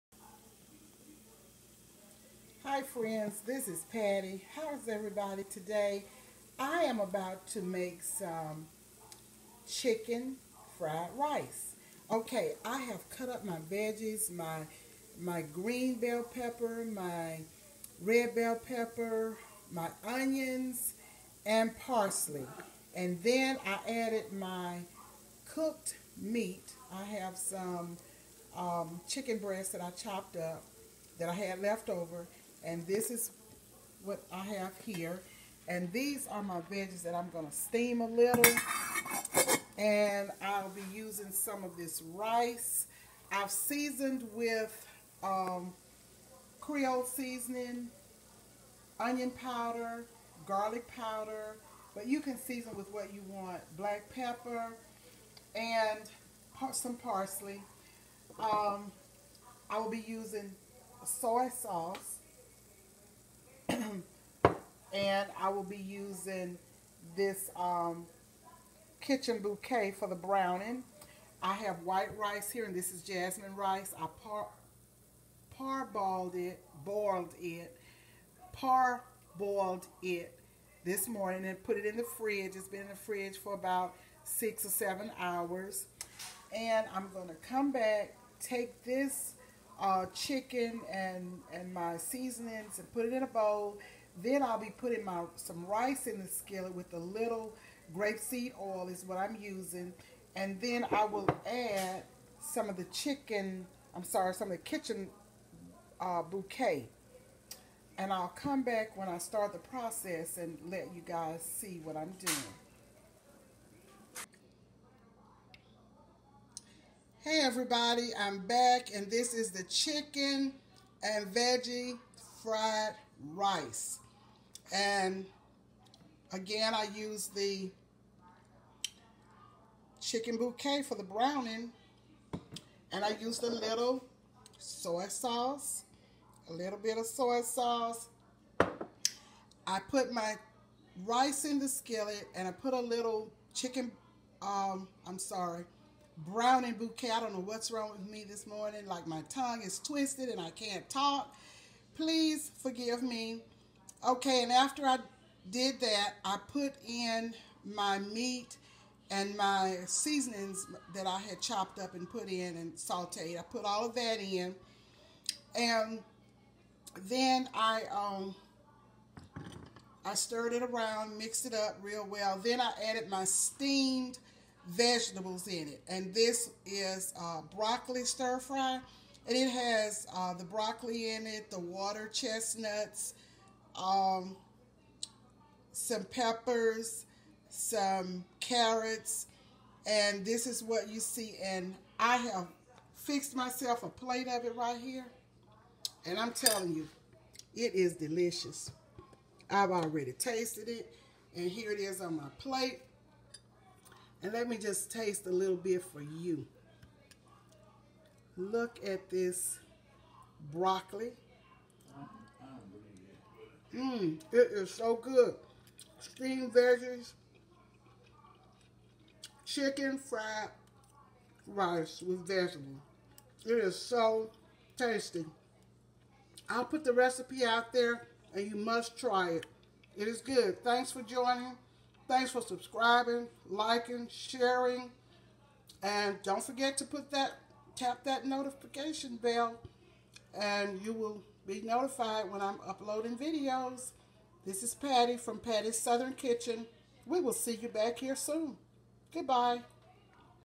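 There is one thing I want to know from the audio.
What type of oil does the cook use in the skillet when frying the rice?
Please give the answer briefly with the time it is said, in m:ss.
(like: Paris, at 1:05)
grapeseed oil, at 1:37.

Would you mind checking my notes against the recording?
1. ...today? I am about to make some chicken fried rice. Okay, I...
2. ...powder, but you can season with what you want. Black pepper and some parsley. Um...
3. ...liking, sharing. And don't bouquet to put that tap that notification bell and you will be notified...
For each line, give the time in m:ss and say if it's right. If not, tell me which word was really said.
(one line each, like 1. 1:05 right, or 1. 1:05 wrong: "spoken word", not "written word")
1. 0:05 right
2. 0:50 right
3. 3:53 wrong: "forget", not "bouquet".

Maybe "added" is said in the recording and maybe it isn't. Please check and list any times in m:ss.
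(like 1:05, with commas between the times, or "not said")
0:23, 2:52.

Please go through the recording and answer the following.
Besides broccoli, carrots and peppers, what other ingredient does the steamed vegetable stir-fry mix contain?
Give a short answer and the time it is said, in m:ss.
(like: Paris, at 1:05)
water chestnuts, at 3:01.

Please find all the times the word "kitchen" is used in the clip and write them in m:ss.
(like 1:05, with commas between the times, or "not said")
1:08, 1:44, 4:06.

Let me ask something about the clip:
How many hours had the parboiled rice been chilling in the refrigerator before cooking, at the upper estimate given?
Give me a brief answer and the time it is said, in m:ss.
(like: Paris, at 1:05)
7, at 1:24.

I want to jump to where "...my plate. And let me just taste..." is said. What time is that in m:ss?
3:22.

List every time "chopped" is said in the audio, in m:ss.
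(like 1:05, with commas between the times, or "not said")
0:29, 2:41.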